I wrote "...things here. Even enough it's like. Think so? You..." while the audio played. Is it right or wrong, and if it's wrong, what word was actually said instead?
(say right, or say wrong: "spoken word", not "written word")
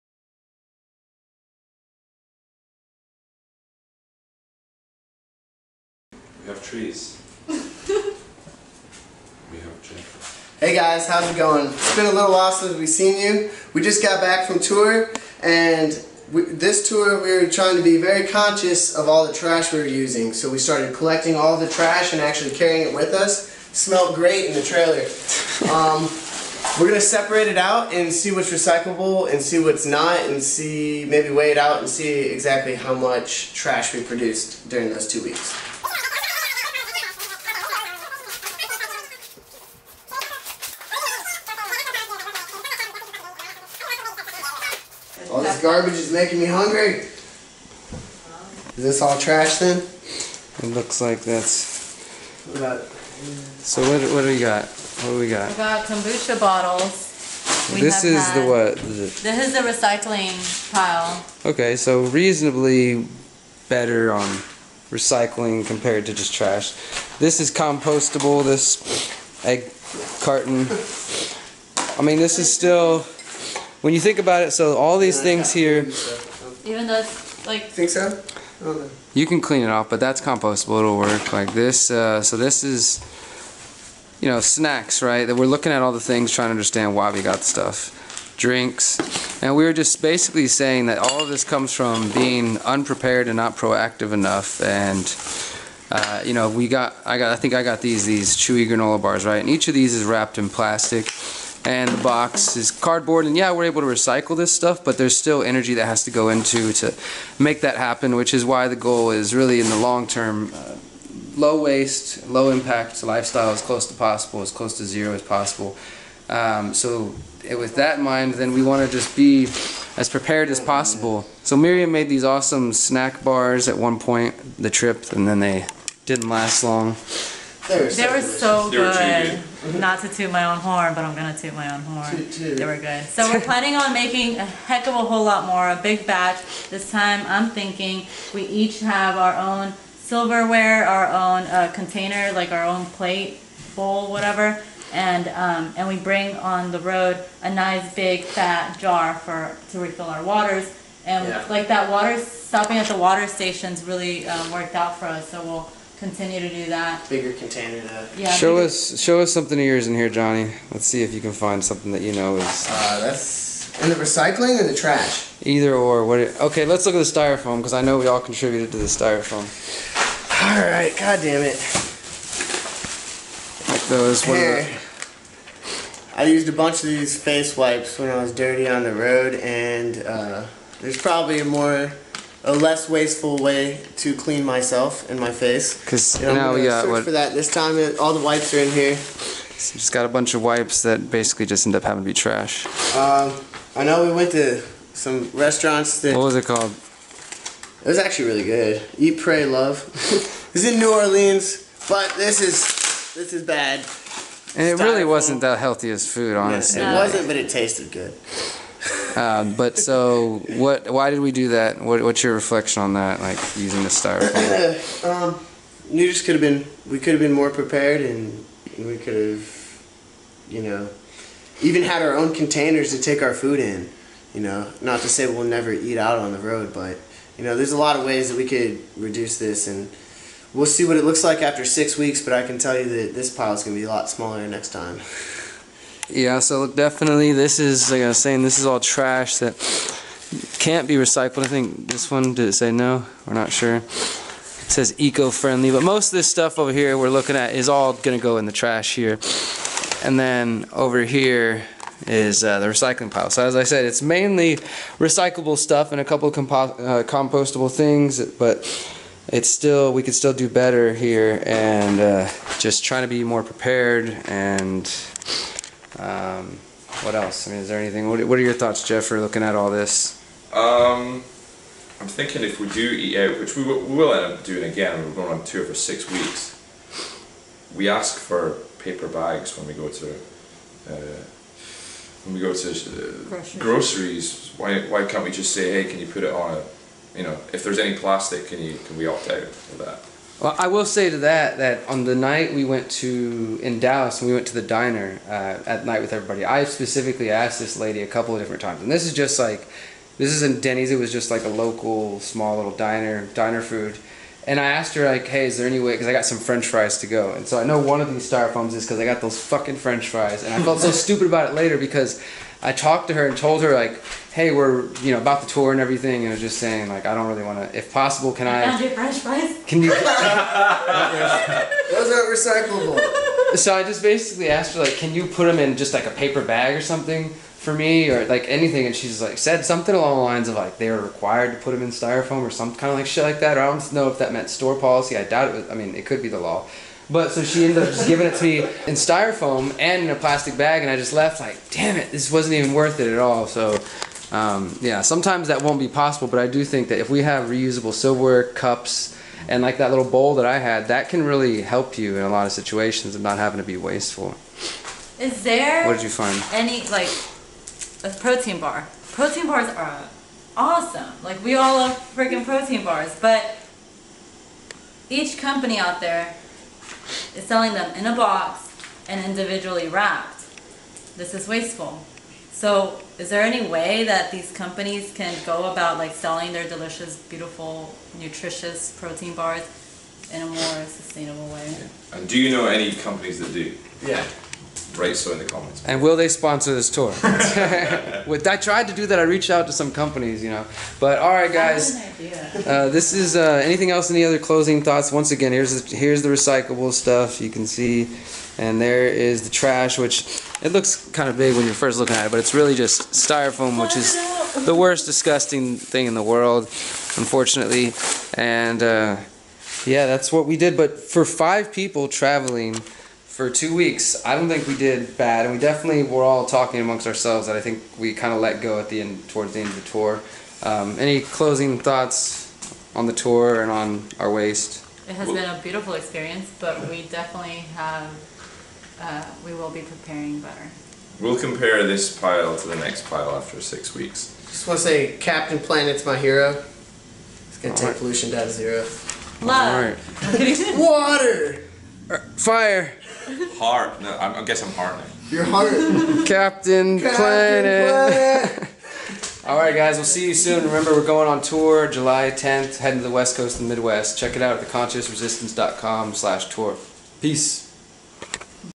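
wrong: "though", not "enough".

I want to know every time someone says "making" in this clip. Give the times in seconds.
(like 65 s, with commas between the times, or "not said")
46 s, 133 s.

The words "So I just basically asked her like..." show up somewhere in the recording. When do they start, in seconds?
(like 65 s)
323 s.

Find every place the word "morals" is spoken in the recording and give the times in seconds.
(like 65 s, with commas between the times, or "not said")
not said.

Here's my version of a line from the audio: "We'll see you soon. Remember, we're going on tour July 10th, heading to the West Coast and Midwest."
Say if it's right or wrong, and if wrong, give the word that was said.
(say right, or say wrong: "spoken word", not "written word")
right.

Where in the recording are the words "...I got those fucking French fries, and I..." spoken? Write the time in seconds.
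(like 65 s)
308 s.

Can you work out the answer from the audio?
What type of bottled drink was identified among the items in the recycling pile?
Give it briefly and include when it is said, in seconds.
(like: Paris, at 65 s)
Kombucha, at 55 s.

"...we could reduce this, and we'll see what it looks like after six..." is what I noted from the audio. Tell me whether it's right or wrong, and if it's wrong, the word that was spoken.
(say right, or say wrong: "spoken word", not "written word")
right.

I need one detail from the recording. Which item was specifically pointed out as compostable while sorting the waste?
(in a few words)
Egg carton.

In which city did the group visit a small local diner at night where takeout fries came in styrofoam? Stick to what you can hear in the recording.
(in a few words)
Dallas.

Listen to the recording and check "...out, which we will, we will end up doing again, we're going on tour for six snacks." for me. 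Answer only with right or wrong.
wrong.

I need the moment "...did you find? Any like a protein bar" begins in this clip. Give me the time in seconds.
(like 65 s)
355 s.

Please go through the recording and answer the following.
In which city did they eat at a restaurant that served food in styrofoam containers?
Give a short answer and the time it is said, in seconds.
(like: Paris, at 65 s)
New Orleans, at 200 s.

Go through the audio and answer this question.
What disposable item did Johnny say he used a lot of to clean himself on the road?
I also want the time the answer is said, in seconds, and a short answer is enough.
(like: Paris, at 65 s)
Face wipes, at 177 s.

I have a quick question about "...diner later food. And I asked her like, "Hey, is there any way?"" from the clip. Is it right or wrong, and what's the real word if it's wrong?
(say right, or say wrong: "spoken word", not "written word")
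wrong: "diner", not "later".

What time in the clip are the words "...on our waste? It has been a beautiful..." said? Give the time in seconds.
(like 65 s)
423 s.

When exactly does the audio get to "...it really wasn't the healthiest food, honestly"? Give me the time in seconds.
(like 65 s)
204 s.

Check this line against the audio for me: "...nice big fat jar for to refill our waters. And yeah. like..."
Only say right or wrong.
right.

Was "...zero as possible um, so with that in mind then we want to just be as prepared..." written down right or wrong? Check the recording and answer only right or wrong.
right.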